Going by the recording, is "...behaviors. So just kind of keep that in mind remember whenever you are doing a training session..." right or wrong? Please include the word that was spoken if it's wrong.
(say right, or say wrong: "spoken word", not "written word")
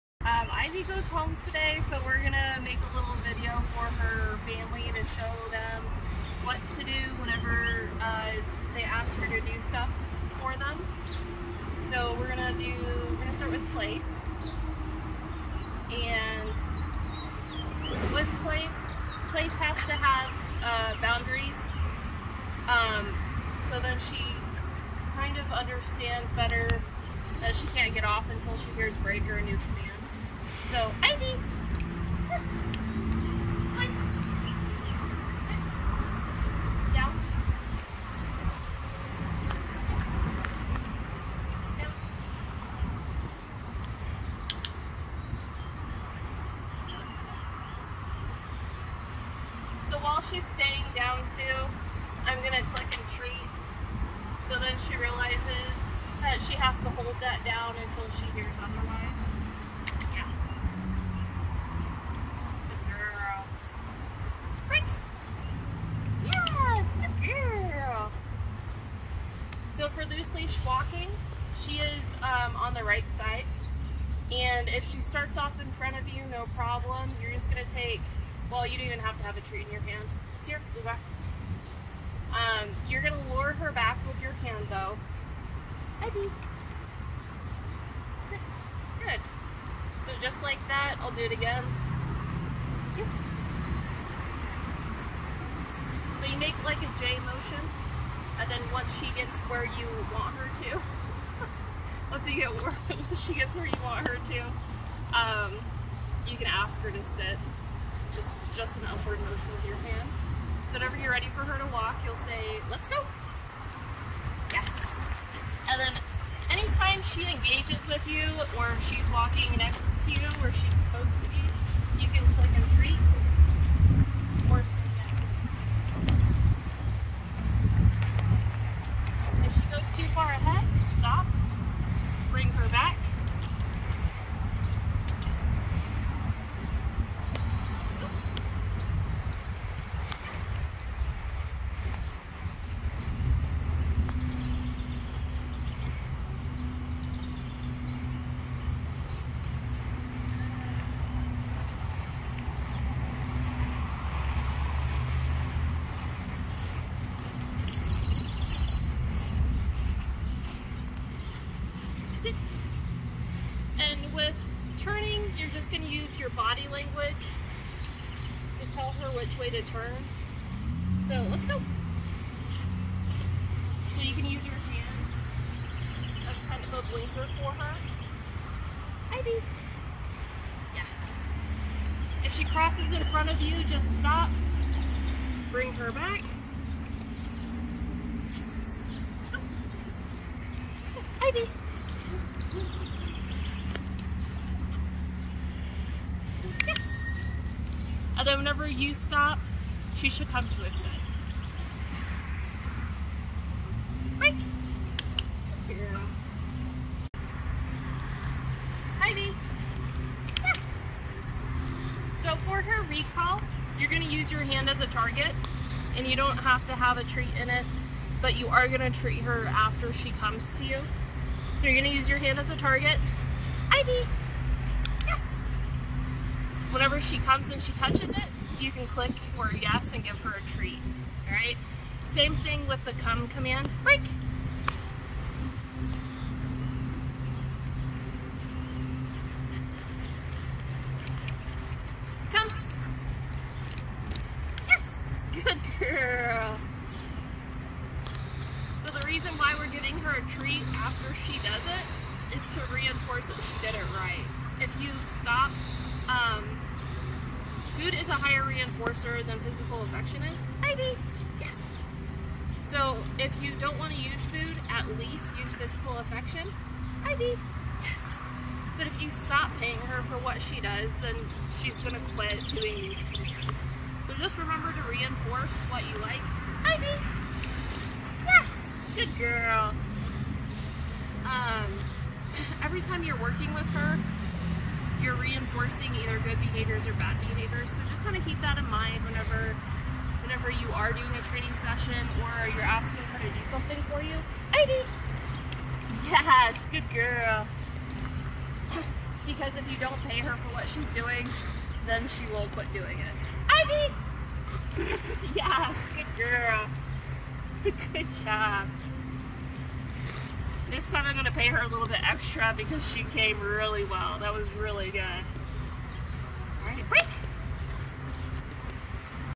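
wrong: "whenever", not "remember".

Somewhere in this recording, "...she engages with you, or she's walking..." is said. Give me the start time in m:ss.
1:57.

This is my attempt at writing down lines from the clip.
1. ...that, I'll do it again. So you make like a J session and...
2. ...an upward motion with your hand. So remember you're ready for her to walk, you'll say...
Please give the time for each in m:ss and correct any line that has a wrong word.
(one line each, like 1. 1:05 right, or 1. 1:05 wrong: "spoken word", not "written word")
1. 1:30 wrong: "motion", not "session"
2. 1:48 wrong: "whenever", not "remember".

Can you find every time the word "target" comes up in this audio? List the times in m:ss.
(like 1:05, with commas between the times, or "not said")
3:34, 3:42.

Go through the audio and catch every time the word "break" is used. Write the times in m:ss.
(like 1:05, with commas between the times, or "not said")
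0:28, 3:24, 3:53, 5:16.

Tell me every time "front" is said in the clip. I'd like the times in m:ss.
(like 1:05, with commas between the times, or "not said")
1:15, 3:03.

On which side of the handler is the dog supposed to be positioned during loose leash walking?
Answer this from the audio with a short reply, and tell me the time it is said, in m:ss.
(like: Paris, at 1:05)
right side, at 1:12.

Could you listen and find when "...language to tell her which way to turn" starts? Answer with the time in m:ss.
2:46.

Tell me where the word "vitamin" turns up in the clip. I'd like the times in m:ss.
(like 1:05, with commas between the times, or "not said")
not said.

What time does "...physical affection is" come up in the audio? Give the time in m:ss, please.
4:19.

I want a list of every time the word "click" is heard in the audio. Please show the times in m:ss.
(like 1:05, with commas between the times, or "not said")
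0:52, 2:02, 3:48.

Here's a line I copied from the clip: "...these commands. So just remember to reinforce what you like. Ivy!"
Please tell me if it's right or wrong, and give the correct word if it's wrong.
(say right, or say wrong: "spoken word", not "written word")
right.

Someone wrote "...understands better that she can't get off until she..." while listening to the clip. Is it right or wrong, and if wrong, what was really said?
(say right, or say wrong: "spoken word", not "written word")
right.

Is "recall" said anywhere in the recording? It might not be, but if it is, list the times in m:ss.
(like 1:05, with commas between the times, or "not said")
3:32.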